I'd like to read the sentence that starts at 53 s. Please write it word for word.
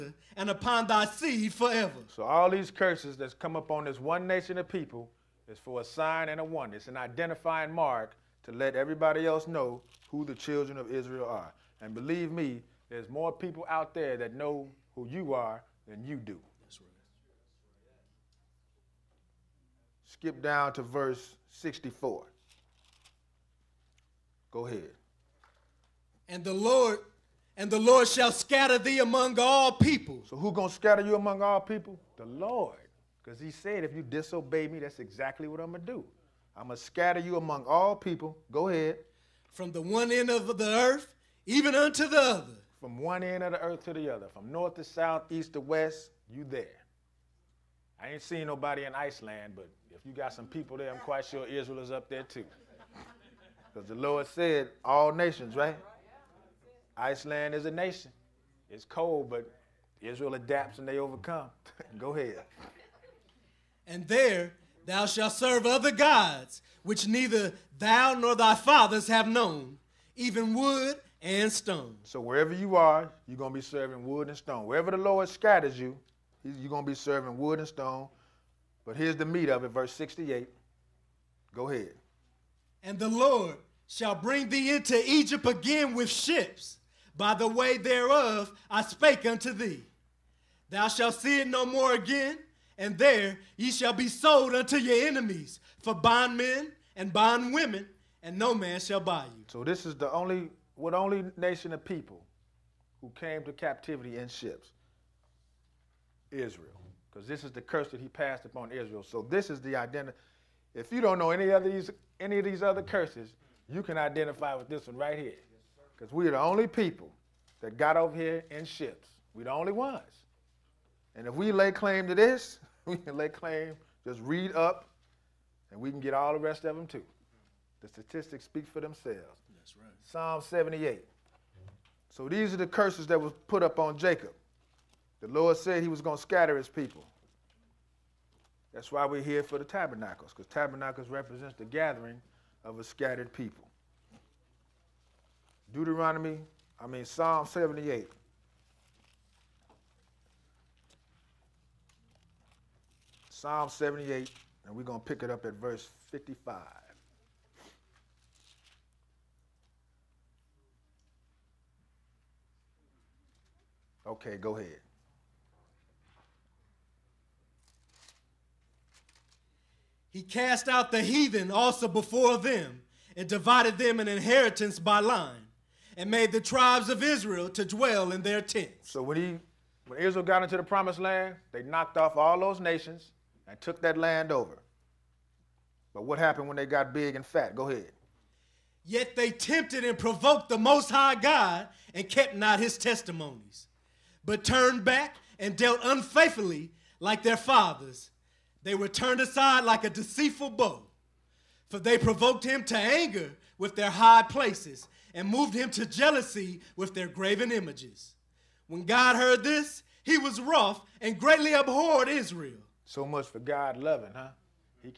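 Because the Lord said, all nations, right?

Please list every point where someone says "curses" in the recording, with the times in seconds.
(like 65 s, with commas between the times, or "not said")
2 s, 107 s, 112 s, 132 s.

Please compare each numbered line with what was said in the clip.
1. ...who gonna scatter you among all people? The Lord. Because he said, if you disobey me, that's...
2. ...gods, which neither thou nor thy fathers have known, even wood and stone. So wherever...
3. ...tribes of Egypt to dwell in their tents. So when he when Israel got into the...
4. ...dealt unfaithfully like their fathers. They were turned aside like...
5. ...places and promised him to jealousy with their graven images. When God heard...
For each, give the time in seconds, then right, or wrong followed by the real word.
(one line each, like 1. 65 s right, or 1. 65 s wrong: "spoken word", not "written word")
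1. 30 s right
2. 65 s right
3. 176 s wrong: "Israel", not "Egypt"
4. 195 s right
5. 204 s wrong: "moved", not "promised".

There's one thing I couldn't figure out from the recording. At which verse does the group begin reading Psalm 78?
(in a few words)
55.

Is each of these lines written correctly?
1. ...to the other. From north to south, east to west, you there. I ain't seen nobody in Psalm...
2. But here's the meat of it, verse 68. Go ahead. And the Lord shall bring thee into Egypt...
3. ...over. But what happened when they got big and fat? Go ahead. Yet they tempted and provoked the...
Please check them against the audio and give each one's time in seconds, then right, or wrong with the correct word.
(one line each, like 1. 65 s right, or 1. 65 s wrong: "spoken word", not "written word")
1. 43 s wrong: "Iceland", not "Psalm"
2. 78 s right
3. 184 s right.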